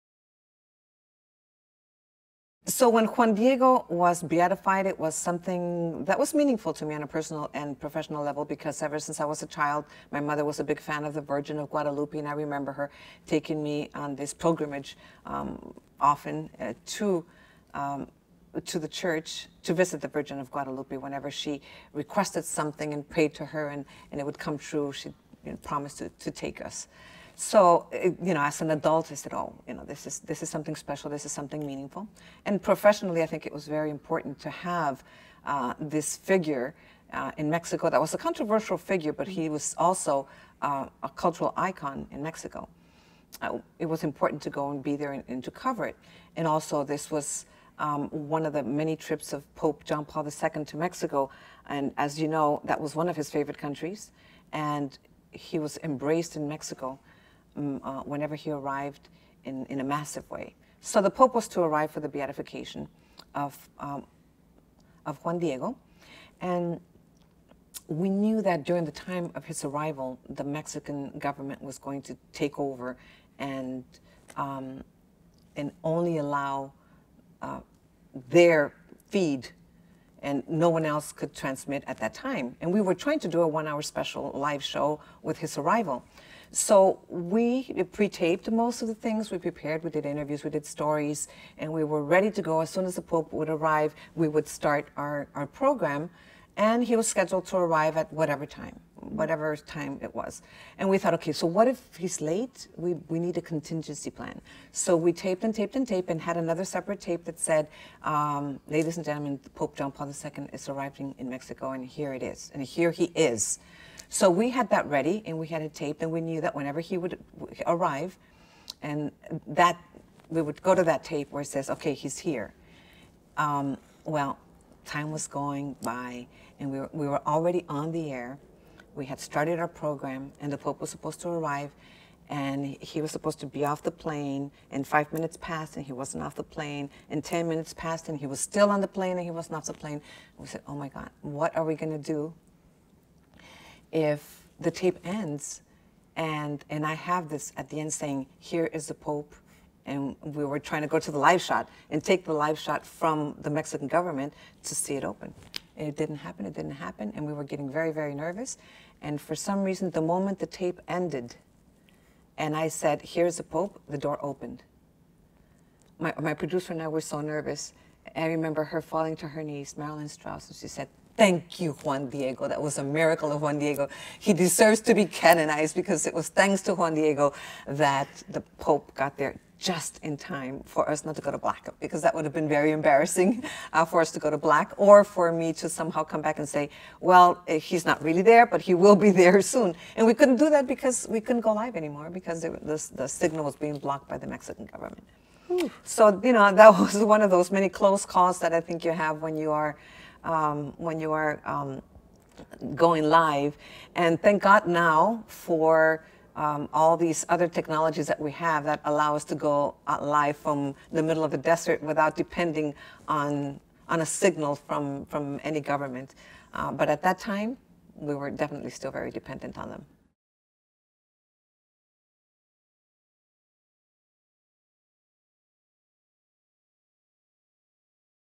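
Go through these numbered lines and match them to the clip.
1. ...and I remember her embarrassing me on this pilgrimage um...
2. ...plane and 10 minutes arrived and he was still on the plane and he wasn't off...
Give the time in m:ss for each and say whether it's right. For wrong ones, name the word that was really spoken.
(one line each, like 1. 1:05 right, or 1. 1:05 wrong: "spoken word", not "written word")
1. 0:12 wrong: "taking", not "embarrassing"
2. 2:16 wrong: "passed", not "arrived".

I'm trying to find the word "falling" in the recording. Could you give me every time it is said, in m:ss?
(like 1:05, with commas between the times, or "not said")
2:48.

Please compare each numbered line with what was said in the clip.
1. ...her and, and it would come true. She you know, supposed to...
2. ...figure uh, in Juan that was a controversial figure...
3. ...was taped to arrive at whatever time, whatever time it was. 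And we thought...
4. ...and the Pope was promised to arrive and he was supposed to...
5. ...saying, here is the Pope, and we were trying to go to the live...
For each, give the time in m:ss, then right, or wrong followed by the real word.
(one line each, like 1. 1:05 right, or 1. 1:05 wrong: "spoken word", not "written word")
1. 0:23 wrong: "promised", not "supposed"
2. 0:36 wrong: "Mexico", not "Juan"
3. 1:36 wrong: "scheduled", not "taped"
4. 2:10 wrong: "supposed", not "promised"
5. 2:27 right.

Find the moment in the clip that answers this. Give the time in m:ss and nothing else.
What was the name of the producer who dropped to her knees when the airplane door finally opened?
2:49.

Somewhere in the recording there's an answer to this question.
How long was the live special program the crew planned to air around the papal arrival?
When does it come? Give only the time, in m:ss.
1:23.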